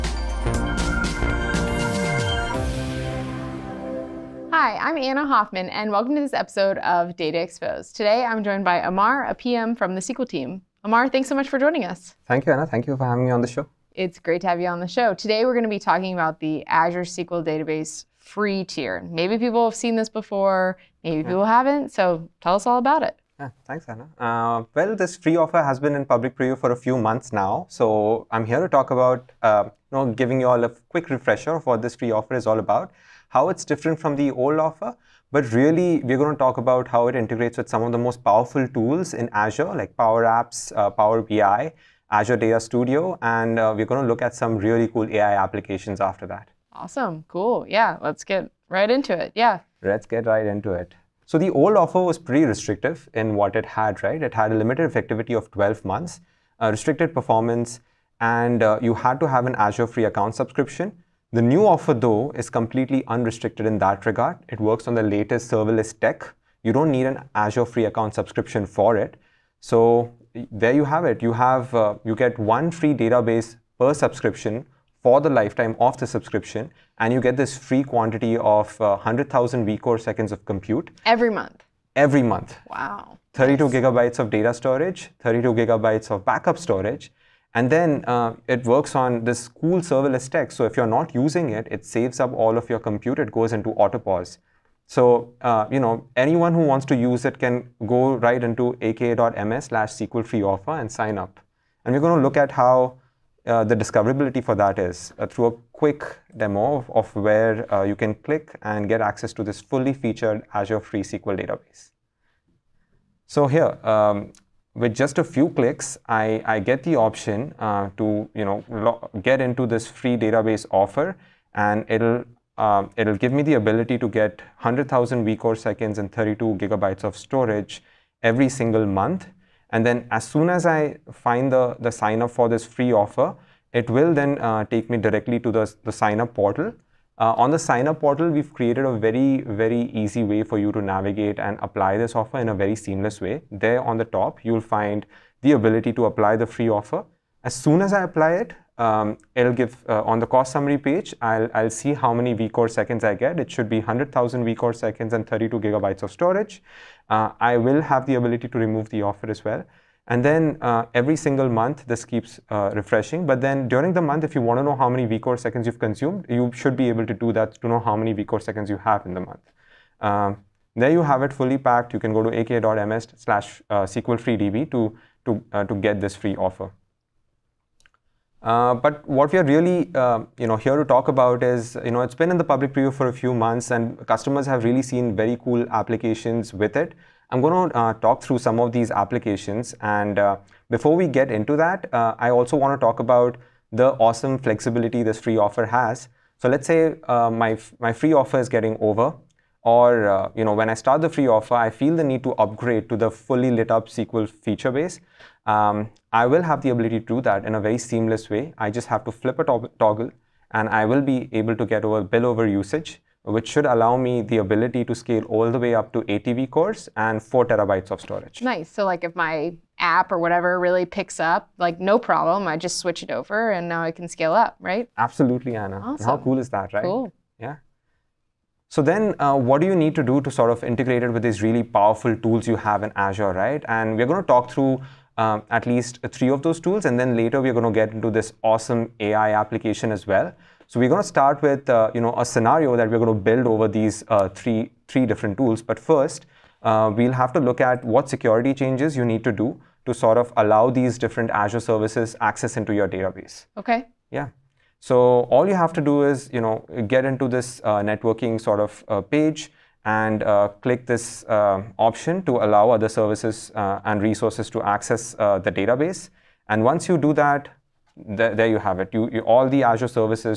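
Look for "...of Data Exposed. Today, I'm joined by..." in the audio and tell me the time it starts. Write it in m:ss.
0:06.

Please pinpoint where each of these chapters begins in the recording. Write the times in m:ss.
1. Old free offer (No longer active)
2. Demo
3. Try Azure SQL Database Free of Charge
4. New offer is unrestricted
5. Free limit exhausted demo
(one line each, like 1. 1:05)
1. 0:50
2. 1:47
3. 1:12
4. 1:02
5. 3:09.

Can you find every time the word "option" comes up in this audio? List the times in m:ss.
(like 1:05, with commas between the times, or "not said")
1:56, 4:21.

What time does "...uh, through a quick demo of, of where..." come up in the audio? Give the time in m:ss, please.
1:45.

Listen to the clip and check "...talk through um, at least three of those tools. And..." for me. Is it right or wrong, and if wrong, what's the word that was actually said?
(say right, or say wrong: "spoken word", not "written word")
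right.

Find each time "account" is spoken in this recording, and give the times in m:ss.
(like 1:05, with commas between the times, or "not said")
1:00, 1:07.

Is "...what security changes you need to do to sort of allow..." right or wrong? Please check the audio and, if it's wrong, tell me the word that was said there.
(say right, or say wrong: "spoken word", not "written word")
right.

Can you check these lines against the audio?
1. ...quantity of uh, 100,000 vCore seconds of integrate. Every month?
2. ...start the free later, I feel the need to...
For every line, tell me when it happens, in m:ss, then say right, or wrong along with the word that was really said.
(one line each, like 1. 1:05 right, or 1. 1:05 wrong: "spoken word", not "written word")
1. 1:17 wrong: "compute", not "integrate"
2. 3:20 wrong: "offer", not "later".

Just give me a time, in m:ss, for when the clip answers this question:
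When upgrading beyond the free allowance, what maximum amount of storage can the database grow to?
3:37.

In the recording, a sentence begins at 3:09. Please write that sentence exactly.
And uh, before we get into that, uh, I also want to talk about the awesome flexibility this free offer has.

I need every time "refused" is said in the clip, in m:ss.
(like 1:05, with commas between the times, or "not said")
not said.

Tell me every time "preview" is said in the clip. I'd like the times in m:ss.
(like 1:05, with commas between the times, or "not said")
0:26, 3:02.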